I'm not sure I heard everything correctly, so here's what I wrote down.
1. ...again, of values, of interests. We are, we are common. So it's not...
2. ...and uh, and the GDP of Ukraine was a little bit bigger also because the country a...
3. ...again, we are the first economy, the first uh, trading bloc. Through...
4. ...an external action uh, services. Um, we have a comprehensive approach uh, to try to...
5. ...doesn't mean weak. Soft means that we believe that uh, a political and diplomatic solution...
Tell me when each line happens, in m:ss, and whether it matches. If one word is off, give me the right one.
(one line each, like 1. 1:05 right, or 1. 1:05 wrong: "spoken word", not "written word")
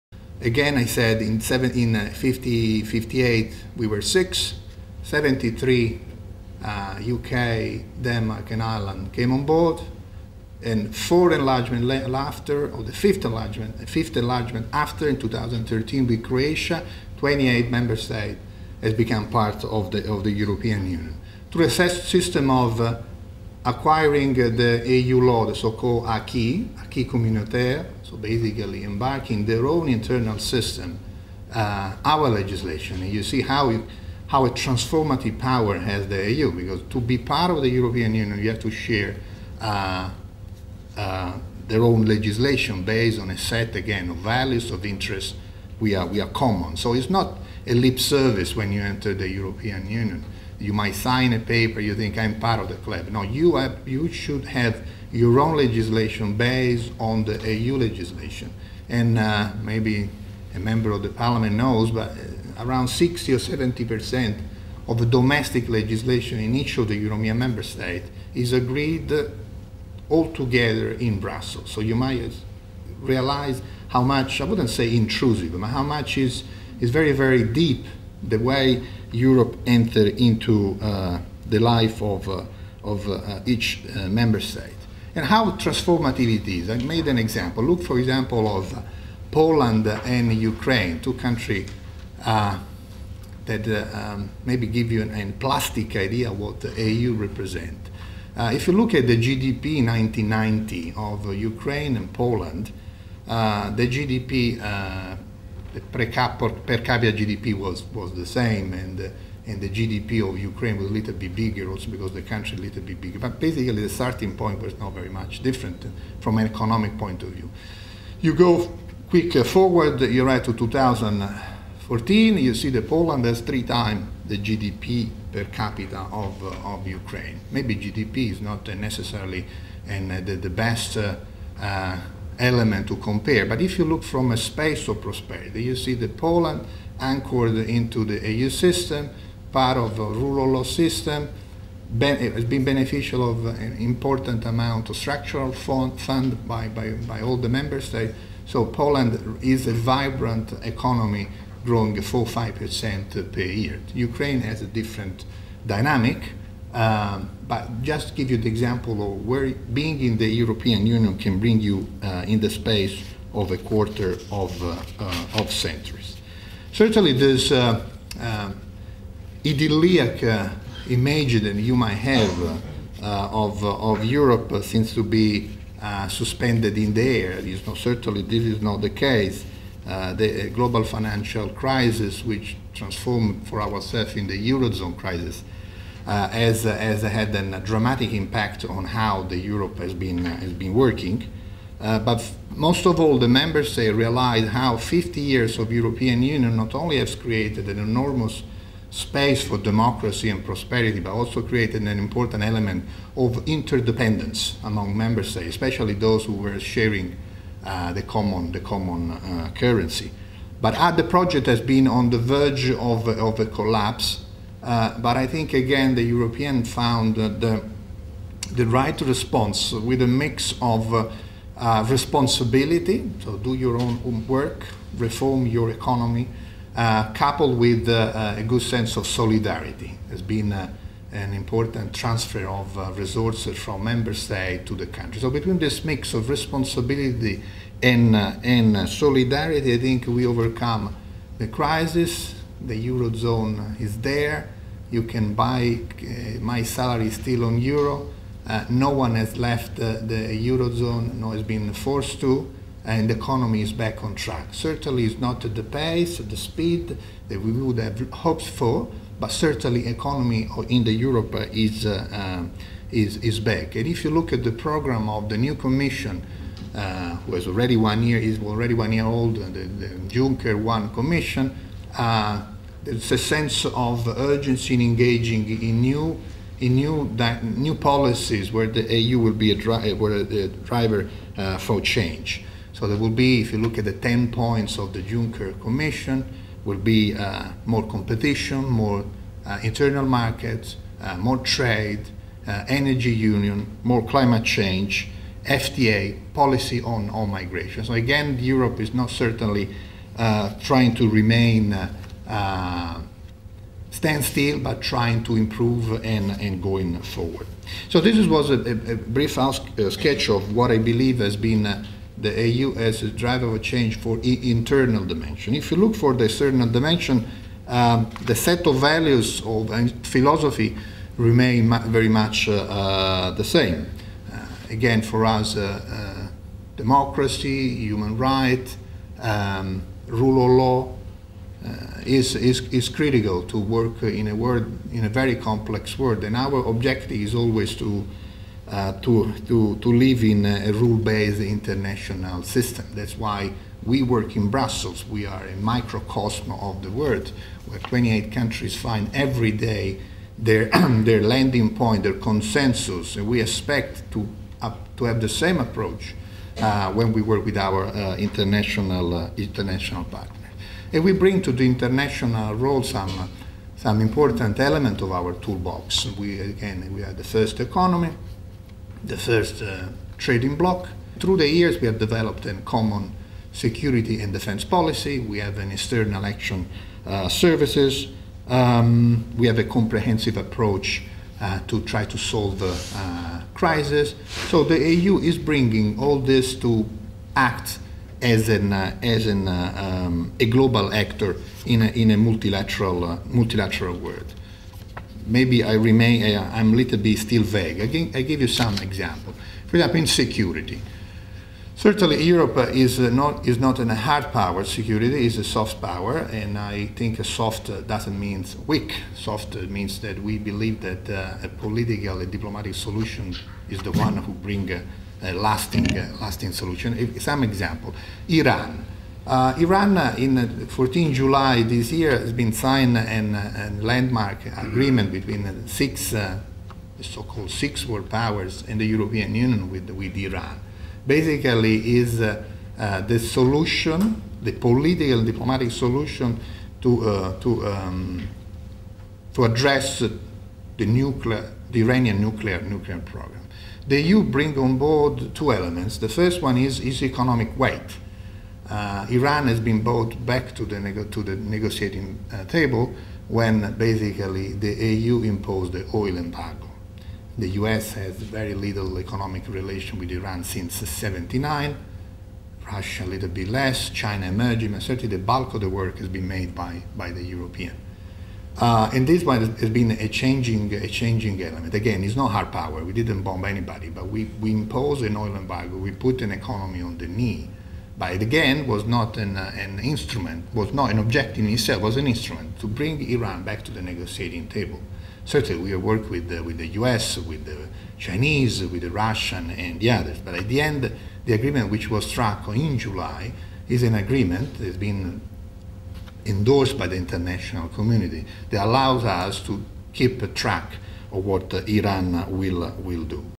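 1. 0:43 right
2. 1:48 right
3. 6:06 right
4. 6:15 right
5. 6:47 right.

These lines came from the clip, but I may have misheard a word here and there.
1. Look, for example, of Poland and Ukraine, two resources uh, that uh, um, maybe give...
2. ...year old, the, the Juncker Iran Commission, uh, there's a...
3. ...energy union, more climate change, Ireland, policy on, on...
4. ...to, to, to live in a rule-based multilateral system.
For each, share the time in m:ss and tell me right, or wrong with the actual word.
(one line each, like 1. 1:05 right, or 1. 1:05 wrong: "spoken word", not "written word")
1. 1:27 wrong: "countries", not "resources"
2. 4:28 wrong: "One", not "Iran"
3. 4:52 wrong: "FTA", not "Ireland"
4. 5:39 wrong: "international", not "multilateral".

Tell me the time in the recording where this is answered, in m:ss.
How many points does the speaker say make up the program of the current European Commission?
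4:43.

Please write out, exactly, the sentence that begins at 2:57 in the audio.
Is certainly this is not the case.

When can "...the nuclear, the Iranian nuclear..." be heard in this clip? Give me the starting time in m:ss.
7:19.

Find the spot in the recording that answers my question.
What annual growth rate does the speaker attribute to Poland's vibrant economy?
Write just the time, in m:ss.
2:32.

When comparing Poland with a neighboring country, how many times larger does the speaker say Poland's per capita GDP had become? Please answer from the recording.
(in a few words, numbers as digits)
3 times.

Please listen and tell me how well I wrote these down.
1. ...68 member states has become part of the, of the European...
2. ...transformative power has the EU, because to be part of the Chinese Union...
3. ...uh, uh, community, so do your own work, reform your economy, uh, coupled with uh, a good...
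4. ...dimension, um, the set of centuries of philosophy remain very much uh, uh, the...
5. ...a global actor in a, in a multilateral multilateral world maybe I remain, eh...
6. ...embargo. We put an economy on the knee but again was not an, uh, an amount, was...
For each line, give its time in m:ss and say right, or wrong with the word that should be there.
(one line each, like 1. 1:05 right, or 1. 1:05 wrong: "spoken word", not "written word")
1. 0:17 wrong: "28", not "68"
2. 0:34 wrong: "European", not "Chinese"
3. 3:40 wrong: "responsibility", not "community"
4. 5:16 wrong: "values", not "centuries"
5. 6:30 right
6. 7:55 wrong: "instrument", not "amount".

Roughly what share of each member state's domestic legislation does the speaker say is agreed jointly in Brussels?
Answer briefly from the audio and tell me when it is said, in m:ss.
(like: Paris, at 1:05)
60 or 70 percent, at 1:02.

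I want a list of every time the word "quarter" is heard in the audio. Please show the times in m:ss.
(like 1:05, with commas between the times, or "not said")
2:43.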